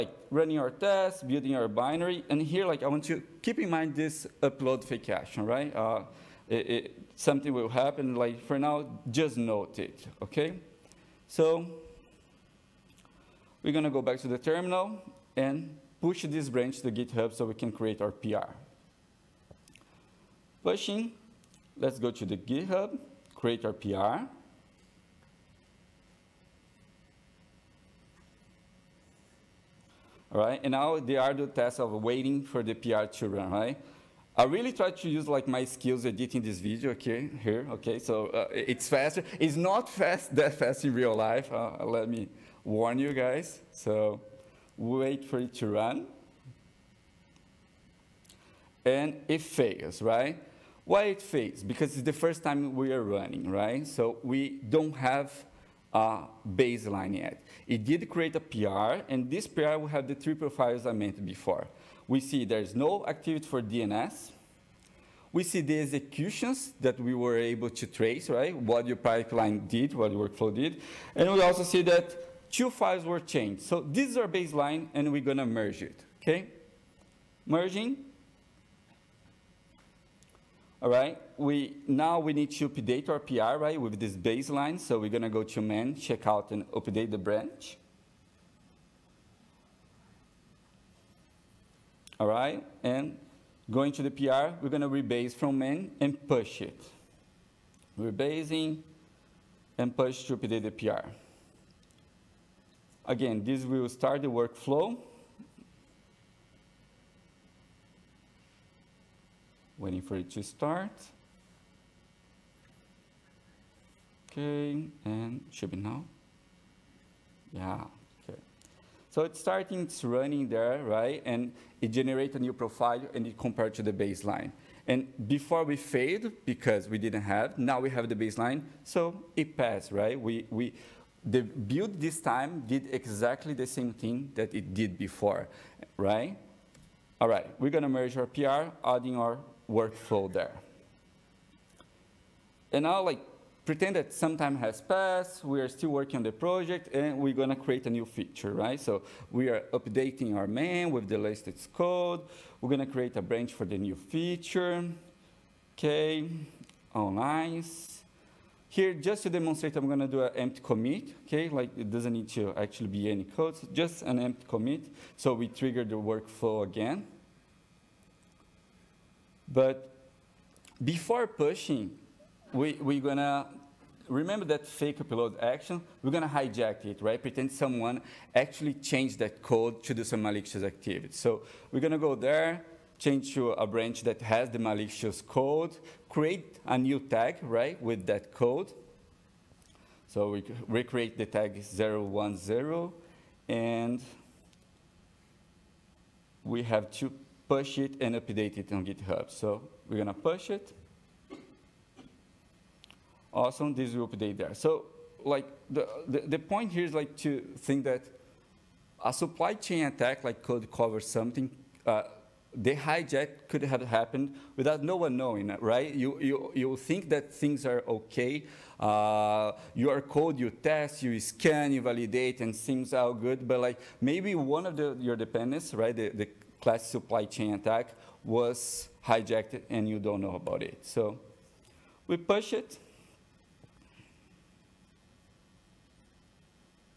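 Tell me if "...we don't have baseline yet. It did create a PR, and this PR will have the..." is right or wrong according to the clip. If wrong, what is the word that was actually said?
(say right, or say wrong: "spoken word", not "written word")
right.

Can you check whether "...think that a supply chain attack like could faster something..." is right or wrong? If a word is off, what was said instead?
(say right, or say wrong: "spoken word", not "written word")
wrong: "cover", not "faster".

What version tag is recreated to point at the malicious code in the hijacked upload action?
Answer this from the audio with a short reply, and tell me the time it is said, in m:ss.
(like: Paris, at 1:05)
010, at 3:11.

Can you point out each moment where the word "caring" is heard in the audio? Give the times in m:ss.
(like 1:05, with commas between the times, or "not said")
not said.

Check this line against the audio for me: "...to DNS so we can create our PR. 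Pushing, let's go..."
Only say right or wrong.
wrong.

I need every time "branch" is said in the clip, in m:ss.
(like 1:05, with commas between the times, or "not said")
0:16, 1:27, 2:33, 3:03.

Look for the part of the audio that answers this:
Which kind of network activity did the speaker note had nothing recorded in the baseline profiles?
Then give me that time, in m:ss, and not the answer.
1:03.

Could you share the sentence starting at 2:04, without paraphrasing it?
And before we failed, because we didn't have, now we have the baseline, so it passed, right?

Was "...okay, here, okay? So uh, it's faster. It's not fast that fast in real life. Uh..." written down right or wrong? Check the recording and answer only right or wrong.
right.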